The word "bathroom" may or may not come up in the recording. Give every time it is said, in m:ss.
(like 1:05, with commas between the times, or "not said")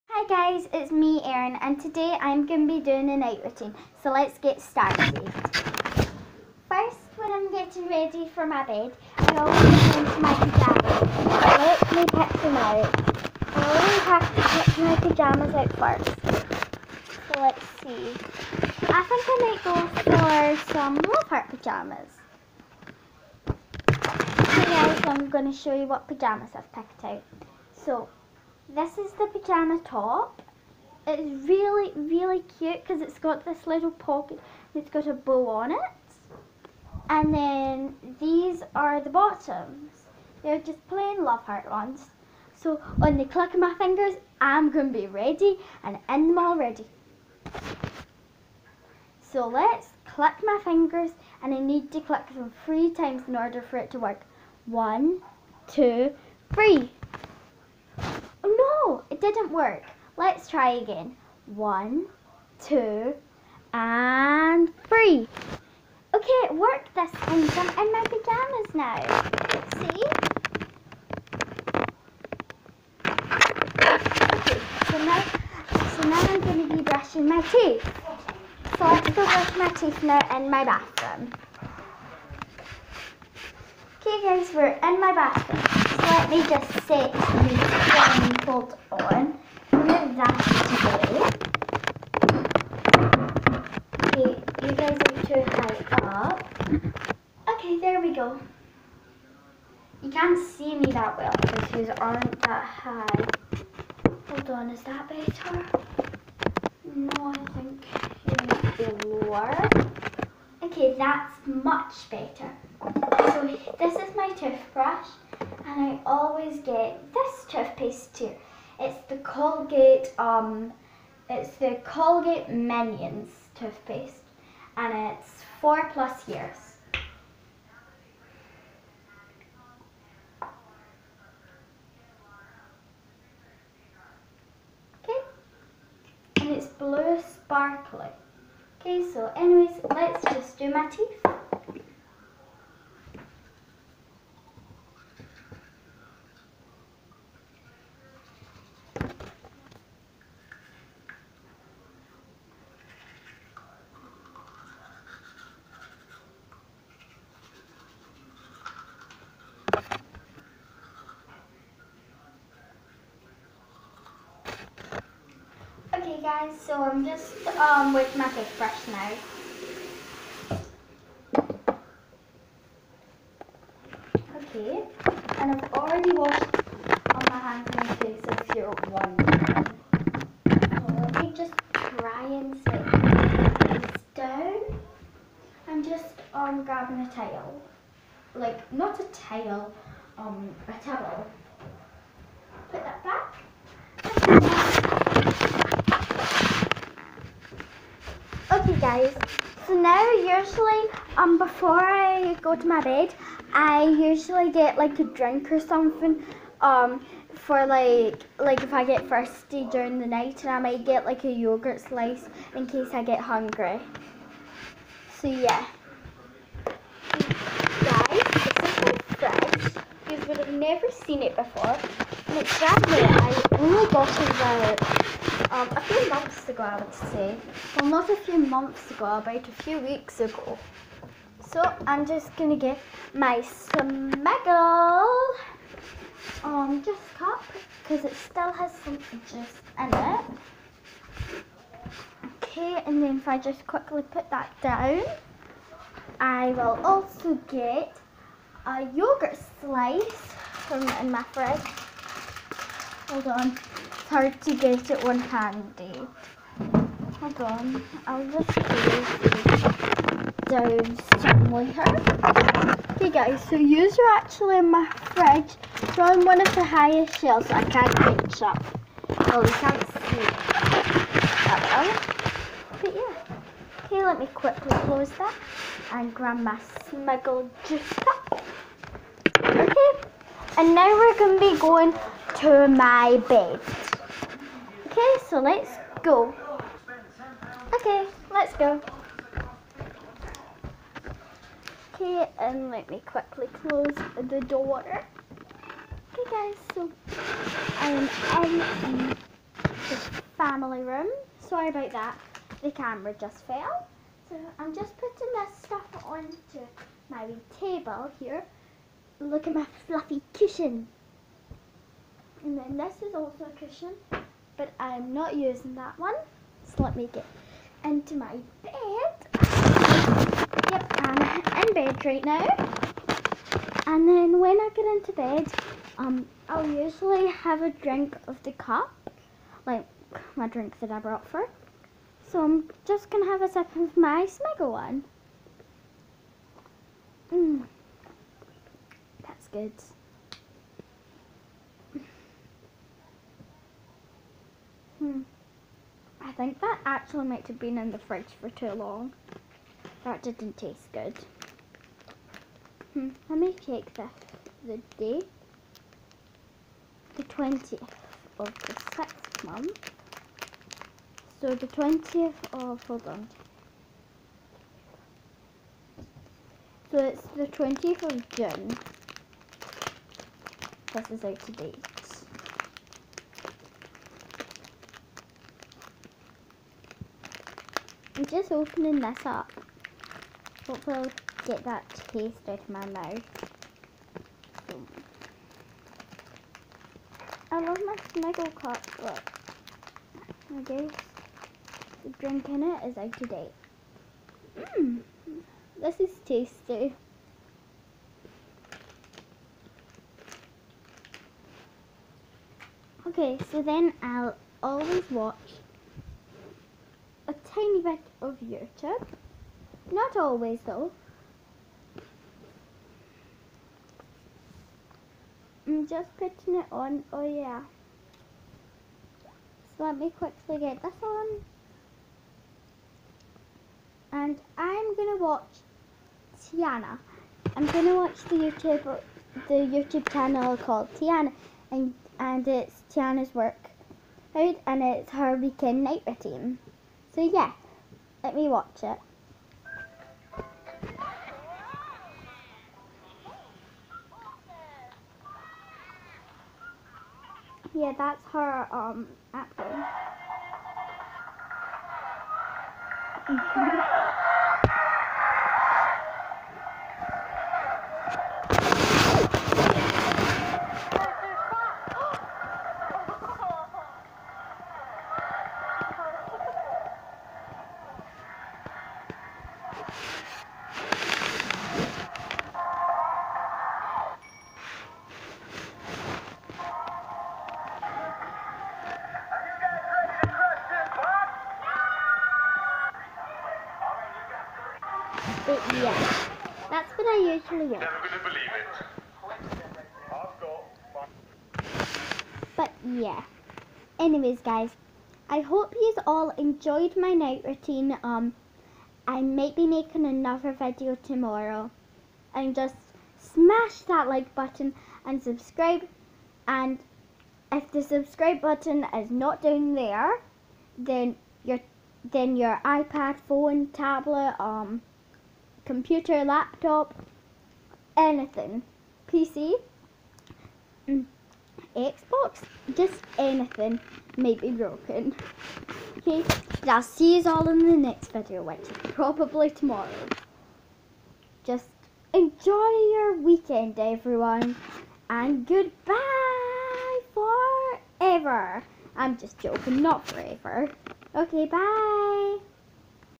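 1:20, 1:25.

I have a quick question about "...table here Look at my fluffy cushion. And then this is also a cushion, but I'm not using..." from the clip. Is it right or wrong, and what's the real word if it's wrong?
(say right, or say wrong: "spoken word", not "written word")
right.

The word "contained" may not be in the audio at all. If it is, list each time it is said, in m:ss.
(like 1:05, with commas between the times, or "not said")
not said.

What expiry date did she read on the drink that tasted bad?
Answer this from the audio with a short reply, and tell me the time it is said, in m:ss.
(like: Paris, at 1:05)
20 June, at 6:07.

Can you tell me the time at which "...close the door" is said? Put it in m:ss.
4:53.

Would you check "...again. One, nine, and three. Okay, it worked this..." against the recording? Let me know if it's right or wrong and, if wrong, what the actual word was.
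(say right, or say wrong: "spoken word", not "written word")
wrong: "two", not "nine".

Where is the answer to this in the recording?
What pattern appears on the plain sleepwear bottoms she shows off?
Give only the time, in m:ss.
0:41.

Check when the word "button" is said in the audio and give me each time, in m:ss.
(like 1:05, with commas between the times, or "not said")
8:24, 8:28.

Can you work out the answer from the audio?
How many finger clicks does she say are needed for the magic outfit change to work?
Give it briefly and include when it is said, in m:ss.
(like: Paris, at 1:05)
3, at 0:52.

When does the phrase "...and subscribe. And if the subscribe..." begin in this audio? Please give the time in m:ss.
8:25.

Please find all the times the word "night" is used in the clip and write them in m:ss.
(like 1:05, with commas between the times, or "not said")
0:03, 3:30, 7:15, 8:17.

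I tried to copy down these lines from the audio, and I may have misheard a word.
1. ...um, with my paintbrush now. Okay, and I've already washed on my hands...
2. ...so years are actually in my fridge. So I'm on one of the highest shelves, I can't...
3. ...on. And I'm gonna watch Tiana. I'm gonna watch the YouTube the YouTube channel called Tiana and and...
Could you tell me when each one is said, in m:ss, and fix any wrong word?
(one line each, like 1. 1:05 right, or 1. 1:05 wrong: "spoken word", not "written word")
1. 2:47 right
2. 4:23 wrong: "yours", not "years"
3. 7:01 right.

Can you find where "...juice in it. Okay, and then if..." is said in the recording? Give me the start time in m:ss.
3:58.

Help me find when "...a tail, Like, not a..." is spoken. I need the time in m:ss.
3:07.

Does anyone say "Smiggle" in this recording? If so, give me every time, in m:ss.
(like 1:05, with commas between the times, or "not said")
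3:53, 5:34, 6:28.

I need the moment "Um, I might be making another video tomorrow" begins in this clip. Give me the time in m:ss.
8:18.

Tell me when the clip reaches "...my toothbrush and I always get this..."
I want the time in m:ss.
1:54.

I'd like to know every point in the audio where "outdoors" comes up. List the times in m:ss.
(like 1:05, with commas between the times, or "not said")
not said.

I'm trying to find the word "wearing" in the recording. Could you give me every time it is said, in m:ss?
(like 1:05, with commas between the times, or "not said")
not said.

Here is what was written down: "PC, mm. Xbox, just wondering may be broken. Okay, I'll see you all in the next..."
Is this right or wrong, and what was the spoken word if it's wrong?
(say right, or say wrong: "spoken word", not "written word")
wrong: "anything", not "wondering".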